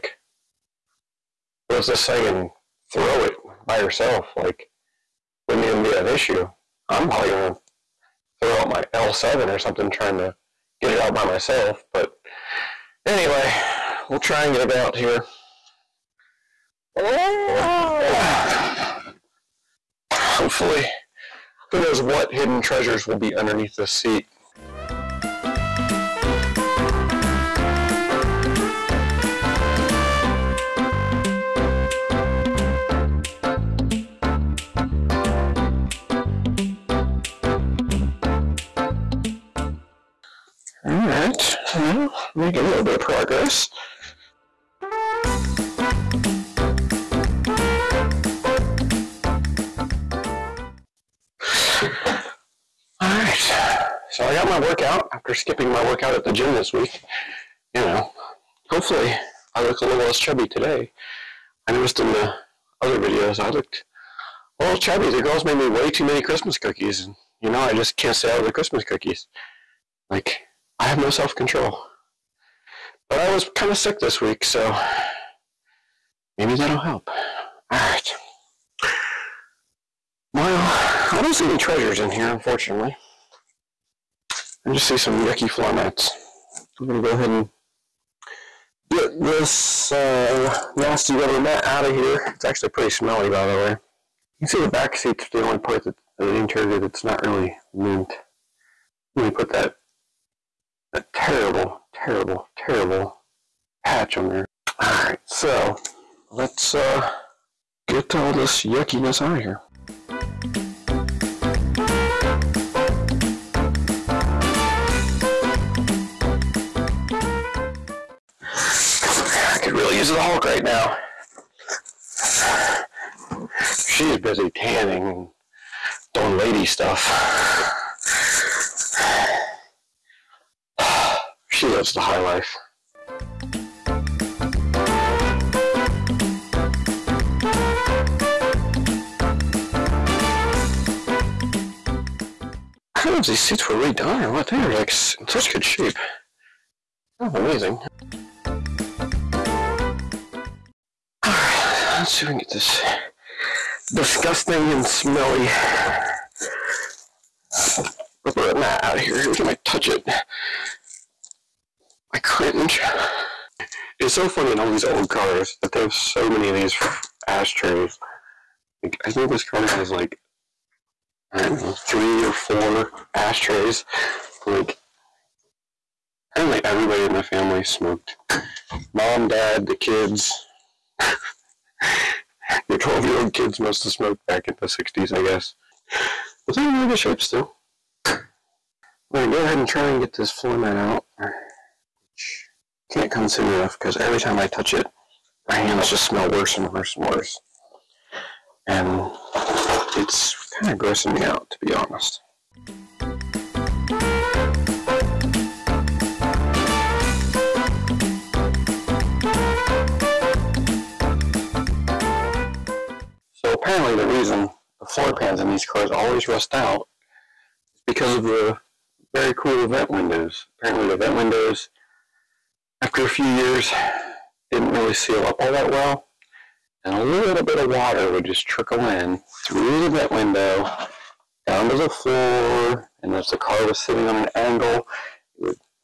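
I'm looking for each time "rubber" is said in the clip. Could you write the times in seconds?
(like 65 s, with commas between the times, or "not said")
91 s, 158 s.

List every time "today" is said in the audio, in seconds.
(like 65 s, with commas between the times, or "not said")
60 s.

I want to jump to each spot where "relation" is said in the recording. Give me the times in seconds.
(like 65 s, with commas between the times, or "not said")
not said.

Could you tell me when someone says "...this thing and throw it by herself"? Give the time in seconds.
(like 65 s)
1 s.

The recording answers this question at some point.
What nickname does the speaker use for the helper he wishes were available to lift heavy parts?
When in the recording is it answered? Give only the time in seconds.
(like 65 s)
120 s.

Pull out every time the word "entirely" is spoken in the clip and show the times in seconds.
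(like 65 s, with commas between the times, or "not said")
not said.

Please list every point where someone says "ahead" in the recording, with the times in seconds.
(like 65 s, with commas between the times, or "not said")
87 s, 189 s.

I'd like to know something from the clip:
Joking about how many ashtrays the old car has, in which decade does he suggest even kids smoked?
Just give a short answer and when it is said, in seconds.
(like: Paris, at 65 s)
the 60s, at 184 s.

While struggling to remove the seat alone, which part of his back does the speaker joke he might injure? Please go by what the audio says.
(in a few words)
L7.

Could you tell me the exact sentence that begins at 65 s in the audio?
The girls made me way too many Christmas cookies.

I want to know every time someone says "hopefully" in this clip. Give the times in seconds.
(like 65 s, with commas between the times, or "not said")
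20 s, 58 s.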